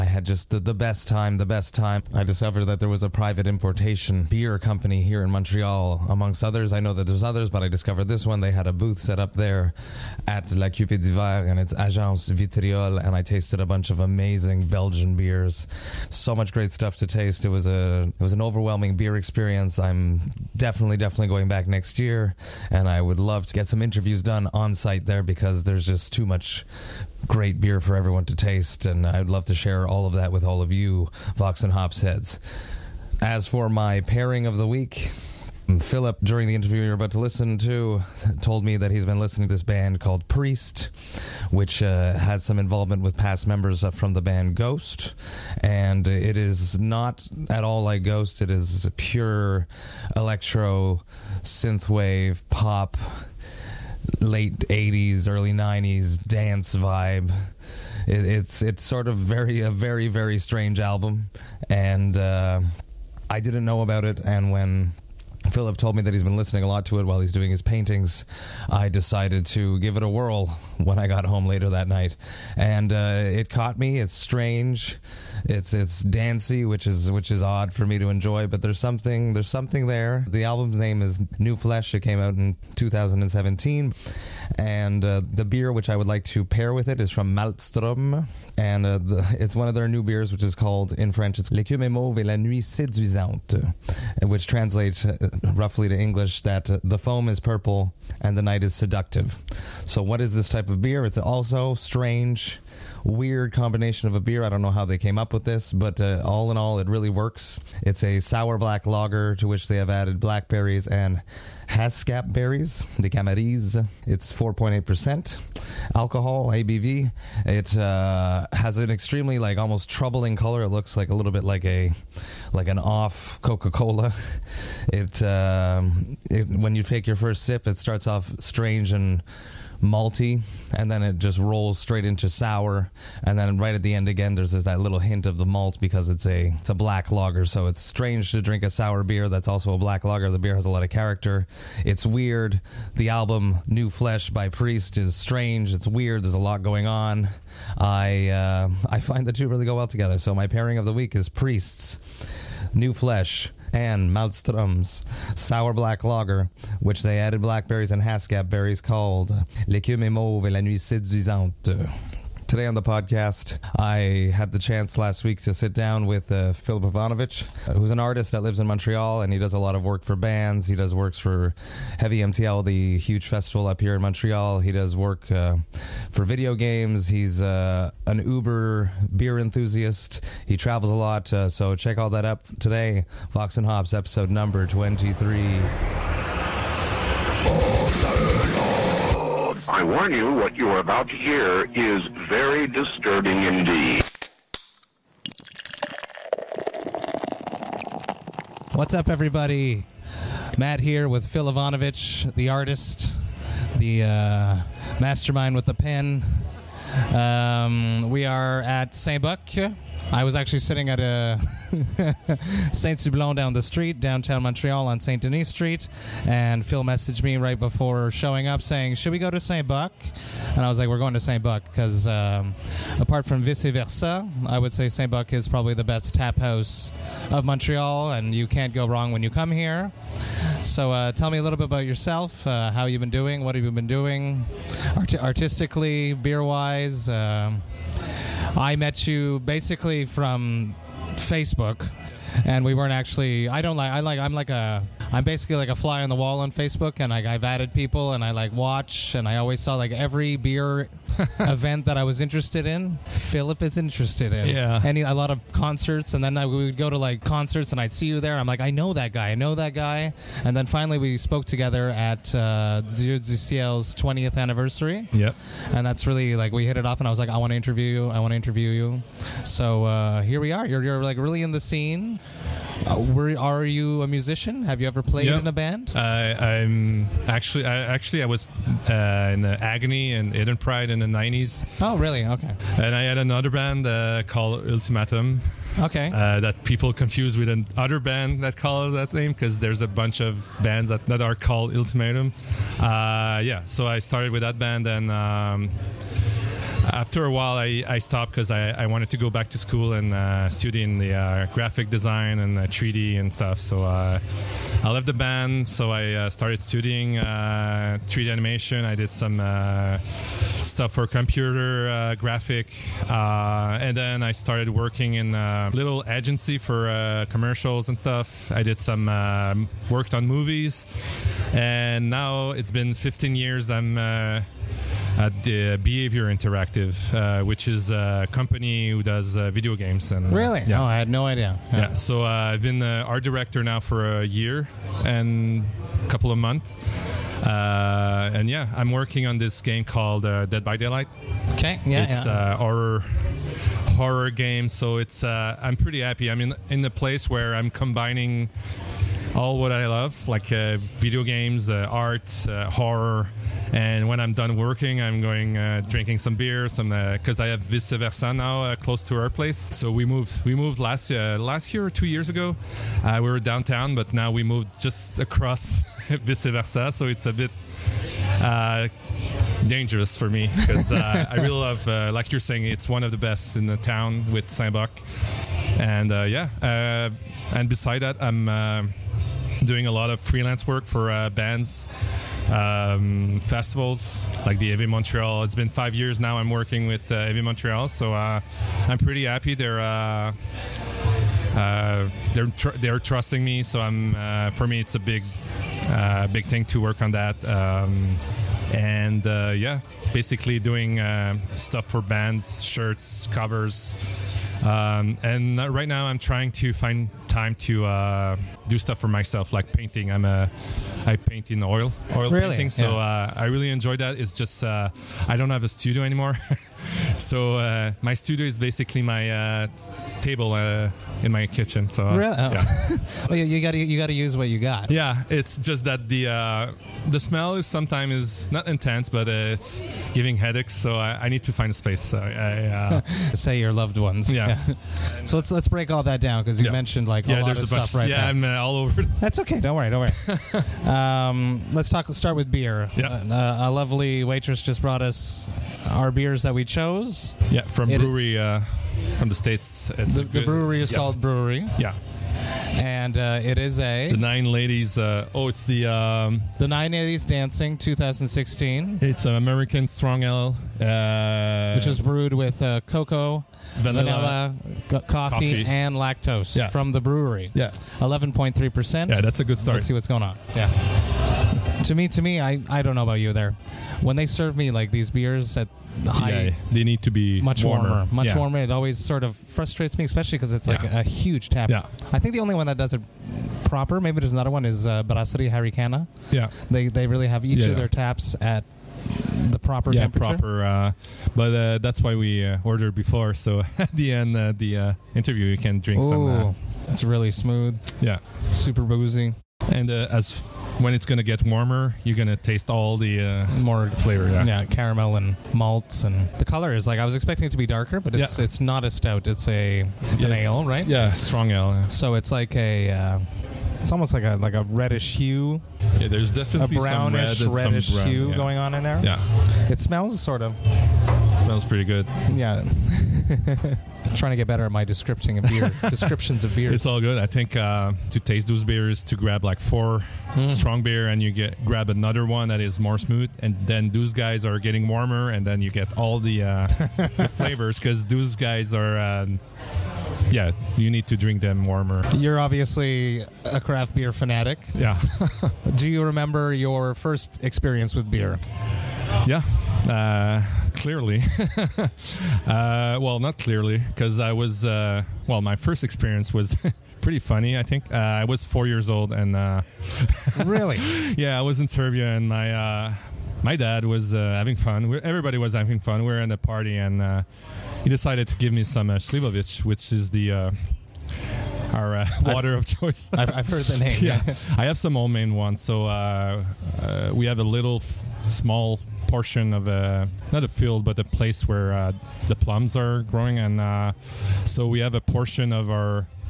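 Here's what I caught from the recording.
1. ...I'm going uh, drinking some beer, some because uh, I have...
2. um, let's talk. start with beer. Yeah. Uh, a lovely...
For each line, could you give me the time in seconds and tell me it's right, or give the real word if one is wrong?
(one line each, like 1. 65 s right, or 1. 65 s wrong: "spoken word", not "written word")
1. 354 s right
2. 440 s right.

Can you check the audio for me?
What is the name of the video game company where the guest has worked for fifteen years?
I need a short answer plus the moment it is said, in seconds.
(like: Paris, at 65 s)
Behaviour Interactive, at 325 s.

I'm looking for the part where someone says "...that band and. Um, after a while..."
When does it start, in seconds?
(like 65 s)
294 s.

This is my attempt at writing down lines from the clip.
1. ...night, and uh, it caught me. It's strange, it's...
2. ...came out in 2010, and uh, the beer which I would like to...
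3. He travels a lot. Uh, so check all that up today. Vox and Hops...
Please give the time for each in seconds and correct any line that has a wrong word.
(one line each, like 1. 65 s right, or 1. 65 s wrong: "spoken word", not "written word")
1. 71 s right
2. 81 s wrong: "2017", not "2010"
3. 180 s right.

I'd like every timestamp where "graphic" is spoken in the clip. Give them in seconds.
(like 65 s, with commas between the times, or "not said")
301 s, 312 s.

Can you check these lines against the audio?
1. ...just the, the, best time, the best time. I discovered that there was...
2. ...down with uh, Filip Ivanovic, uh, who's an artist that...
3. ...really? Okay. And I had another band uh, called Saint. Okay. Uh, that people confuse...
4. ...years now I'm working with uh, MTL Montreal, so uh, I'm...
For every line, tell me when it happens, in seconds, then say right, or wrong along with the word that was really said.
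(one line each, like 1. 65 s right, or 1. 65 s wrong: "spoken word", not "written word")
1. 0 s right
2. 165 s right
3. 281 s wrong: "Ultimatum", not "Saint"
4. 385 s wrong: "Heavy", not "MTL".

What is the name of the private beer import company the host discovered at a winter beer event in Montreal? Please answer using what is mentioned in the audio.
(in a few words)
Agence Vitriol.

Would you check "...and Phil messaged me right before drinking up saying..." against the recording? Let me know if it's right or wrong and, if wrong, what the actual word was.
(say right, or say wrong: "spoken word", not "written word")
wrong: "showing", not "drinking".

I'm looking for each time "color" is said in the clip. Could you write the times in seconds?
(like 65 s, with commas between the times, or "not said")
120 s, 506 s.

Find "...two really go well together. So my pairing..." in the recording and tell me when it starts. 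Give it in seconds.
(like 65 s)
149 s.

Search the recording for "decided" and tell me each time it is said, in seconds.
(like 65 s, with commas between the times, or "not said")
68 s, 567 s.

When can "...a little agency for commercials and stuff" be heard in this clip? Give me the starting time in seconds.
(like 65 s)
315 s.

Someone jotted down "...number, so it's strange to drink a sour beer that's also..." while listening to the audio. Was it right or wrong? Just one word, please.
wrong.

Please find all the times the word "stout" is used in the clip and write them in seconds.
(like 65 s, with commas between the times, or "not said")
508 s.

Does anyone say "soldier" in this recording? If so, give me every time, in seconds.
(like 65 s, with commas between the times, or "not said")
not said.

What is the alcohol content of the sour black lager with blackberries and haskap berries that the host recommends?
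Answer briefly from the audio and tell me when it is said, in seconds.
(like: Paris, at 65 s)
4.8%, at 114 s.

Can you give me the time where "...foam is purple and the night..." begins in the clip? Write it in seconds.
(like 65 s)
96 s.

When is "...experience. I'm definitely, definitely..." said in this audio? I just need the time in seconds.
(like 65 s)
19 s.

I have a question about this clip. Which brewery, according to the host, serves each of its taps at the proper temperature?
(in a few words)
Brasserie Harricana.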